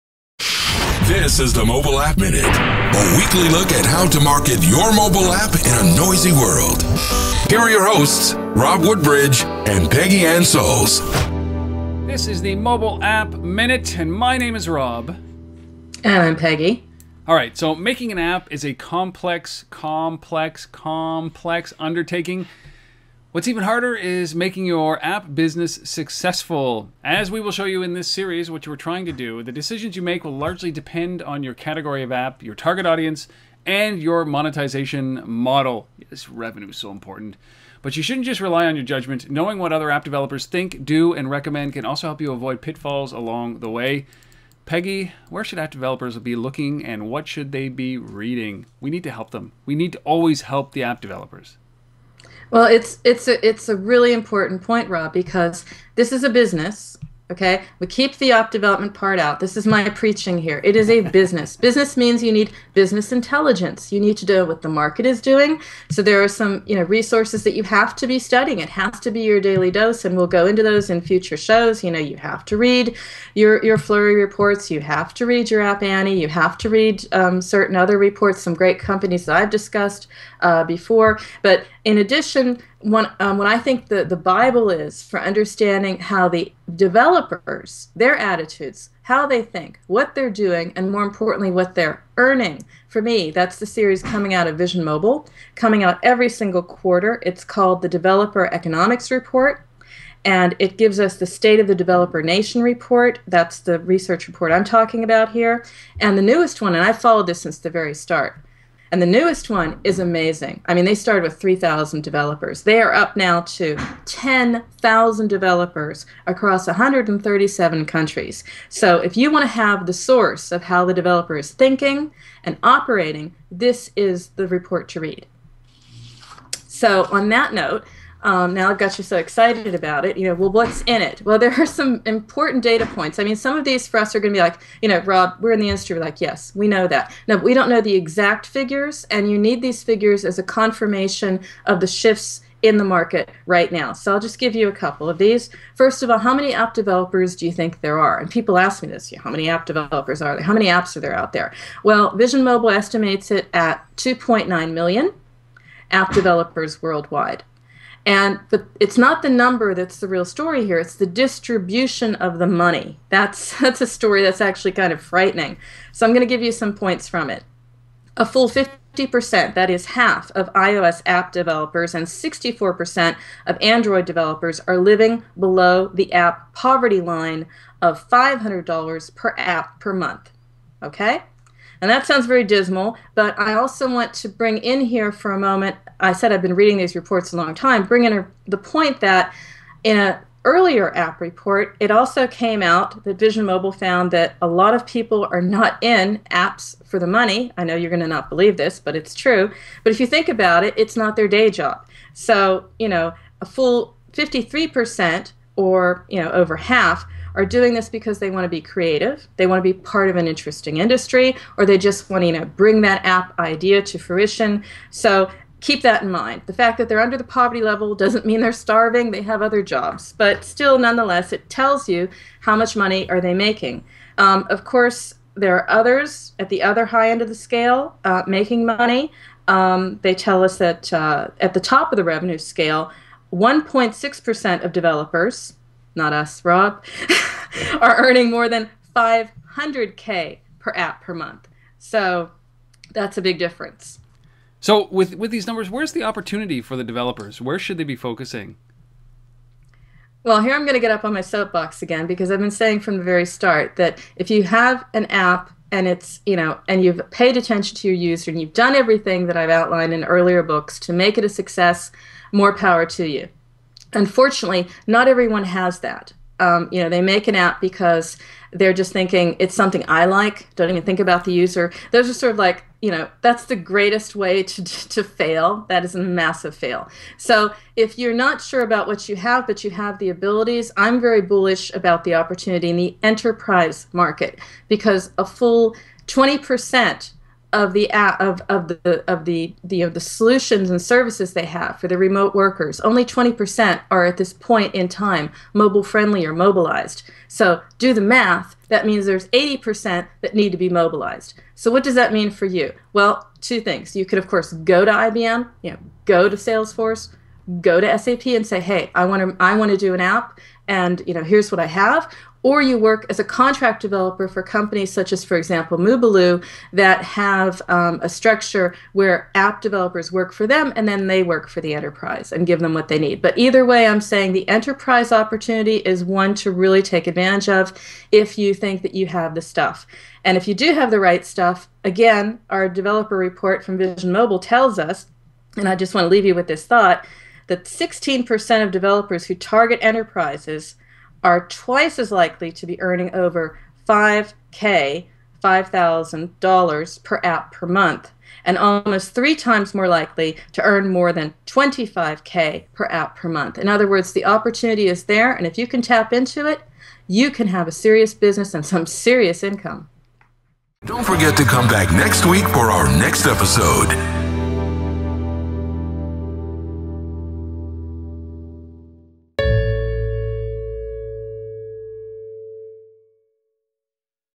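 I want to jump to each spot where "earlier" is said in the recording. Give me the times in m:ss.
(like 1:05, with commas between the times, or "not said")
3:10, 4:20.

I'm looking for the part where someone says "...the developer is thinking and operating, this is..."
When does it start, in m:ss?
2:00.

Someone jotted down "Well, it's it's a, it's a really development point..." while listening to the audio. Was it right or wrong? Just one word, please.
wrong.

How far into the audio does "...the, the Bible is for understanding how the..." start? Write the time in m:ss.
1:23.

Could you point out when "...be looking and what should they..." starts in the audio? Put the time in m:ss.
0:46.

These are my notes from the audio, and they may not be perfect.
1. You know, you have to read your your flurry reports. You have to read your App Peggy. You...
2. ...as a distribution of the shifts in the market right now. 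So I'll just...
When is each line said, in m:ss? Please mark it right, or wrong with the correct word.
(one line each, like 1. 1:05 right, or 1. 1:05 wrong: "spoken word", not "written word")
1. 1:11 wrong: "Annie", not "Peggy"
2. 2:20 wrong: "confirmation", not "distribution".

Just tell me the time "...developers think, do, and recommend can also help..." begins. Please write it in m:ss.
0:40.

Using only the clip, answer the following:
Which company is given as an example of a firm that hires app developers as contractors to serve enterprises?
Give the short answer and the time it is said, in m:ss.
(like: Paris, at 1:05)
Mubaloo, at 5:15.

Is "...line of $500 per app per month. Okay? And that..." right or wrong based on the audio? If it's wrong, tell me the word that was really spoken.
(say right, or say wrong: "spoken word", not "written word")
right.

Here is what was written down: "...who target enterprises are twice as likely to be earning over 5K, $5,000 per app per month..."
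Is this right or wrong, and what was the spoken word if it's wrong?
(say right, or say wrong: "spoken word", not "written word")
right.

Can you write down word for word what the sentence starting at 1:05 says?
So there are some, you know, resources that you have to be studying.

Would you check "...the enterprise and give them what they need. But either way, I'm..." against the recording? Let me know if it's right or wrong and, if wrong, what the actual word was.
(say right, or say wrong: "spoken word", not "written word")
right.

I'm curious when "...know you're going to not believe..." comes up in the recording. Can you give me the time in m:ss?
3:17.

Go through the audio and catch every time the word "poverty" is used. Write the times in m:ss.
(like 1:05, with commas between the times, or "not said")
2:56, 3:37.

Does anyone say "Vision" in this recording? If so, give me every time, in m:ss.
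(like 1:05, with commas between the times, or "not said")
1:34, 2:32, 3:13, 5:33.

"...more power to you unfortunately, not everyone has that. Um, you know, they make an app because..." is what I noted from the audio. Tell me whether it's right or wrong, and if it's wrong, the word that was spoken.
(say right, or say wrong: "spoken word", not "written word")
right.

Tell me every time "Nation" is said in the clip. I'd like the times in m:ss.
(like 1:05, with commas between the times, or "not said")
1:42.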